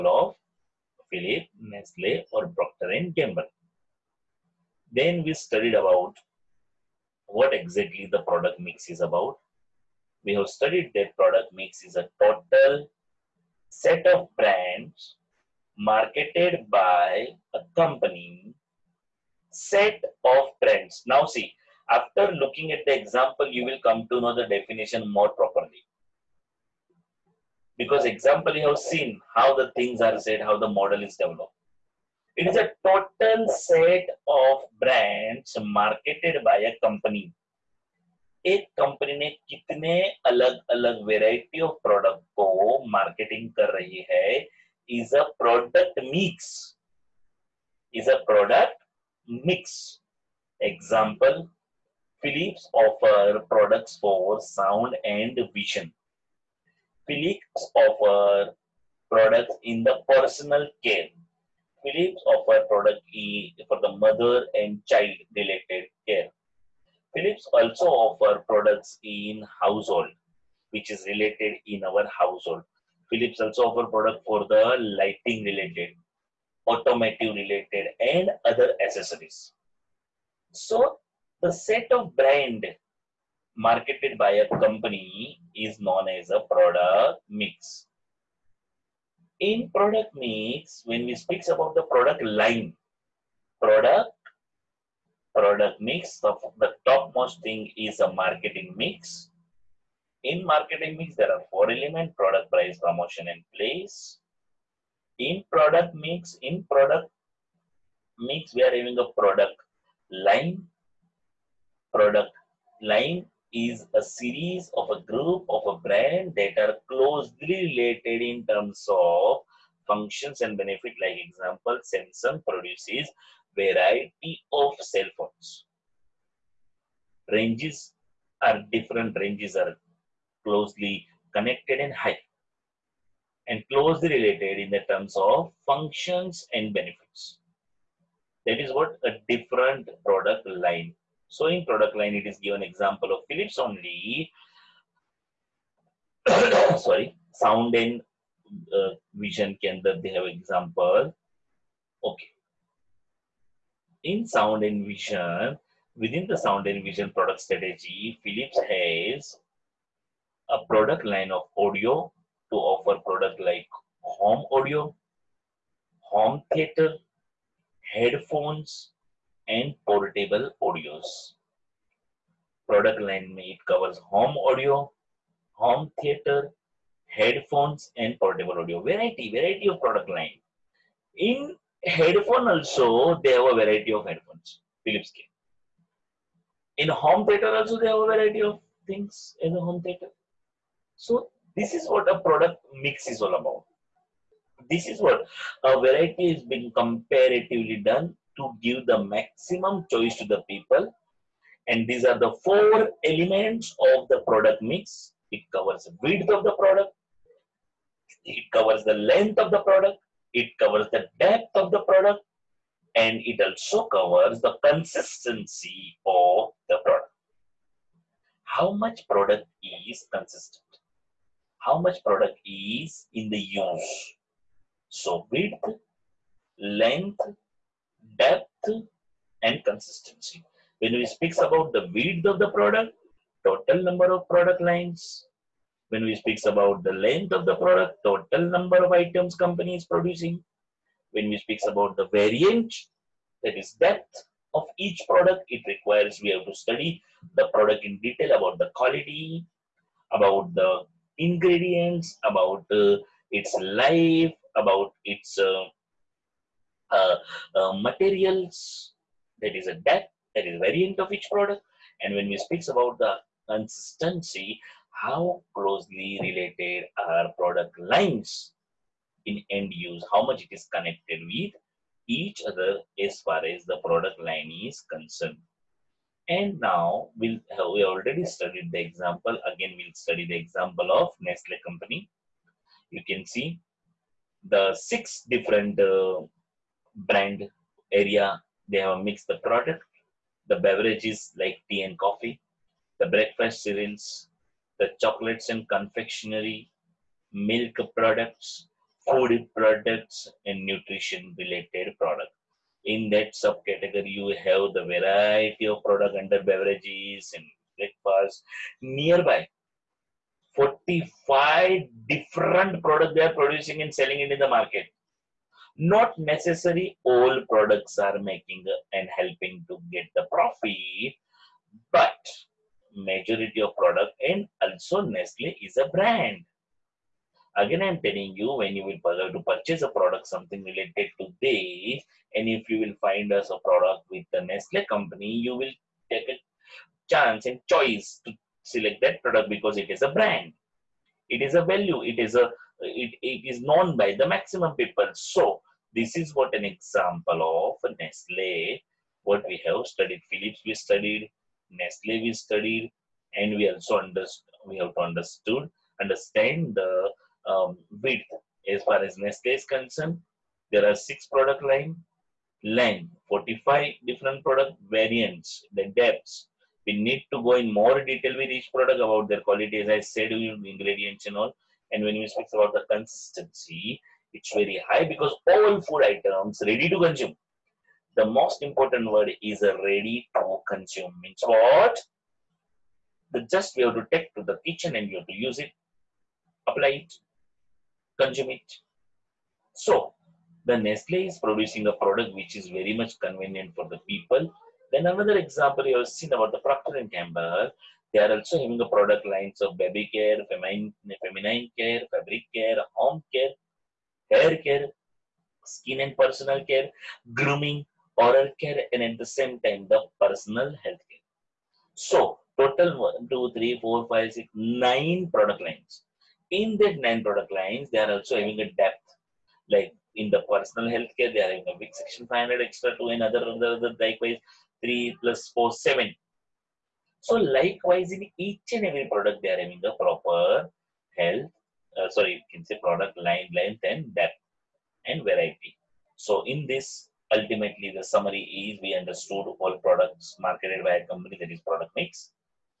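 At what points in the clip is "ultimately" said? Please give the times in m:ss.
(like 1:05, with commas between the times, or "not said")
7:17.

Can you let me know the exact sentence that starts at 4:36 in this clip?
And now we'll, uh, we already studied the example.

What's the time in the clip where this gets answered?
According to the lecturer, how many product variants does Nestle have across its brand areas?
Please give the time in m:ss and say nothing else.
5:10.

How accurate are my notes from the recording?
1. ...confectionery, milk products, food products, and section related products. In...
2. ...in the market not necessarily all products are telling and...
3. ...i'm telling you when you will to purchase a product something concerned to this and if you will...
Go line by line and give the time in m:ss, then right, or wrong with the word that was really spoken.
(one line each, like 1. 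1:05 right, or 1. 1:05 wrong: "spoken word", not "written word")
1. 4:55 wrong: "nutrition", not "section"
2. 5:14 wrong: "making", not "telling"
3. 5:27 wrong: "related", not "concerned".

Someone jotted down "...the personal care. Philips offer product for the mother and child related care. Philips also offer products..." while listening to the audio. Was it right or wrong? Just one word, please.
right.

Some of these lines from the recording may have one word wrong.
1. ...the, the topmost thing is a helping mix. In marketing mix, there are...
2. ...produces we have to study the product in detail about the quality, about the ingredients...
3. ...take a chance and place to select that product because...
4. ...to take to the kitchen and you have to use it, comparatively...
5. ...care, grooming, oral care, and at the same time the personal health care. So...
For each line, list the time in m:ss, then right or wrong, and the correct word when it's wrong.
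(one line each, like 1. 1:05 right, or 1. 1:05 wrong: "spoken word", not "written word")
1. 1:36 wrong: "marketing", not "helping"
2. 4:05 wrong: "requires", not "produces"
3. 5:36 wrong: "choice", not "place"
4. 6:23 wrong: "apply", not "comparatively"
5. 6:46 right.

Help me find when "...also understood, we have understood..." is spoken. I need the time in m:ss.
5:53.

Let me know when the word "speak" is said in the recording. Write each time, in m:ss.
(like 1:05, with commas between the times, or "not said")
1:31, 3:51, 3:56, 4:01, 4:22, 6:12.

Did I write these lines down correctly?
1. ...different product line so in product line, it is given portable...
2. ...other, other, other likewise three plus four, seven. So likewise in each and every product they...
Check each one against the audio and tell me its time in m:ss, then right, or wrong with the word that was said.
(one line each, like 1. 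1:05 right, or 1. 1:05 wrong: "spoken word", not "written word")
1. 2:19 wrong: "example", not "portable"
2. 7:03 right.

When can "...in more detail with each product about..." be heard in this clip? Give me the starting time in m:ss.
6:07.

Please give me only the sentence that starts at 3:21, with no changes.
And these are the four elements of the product mix.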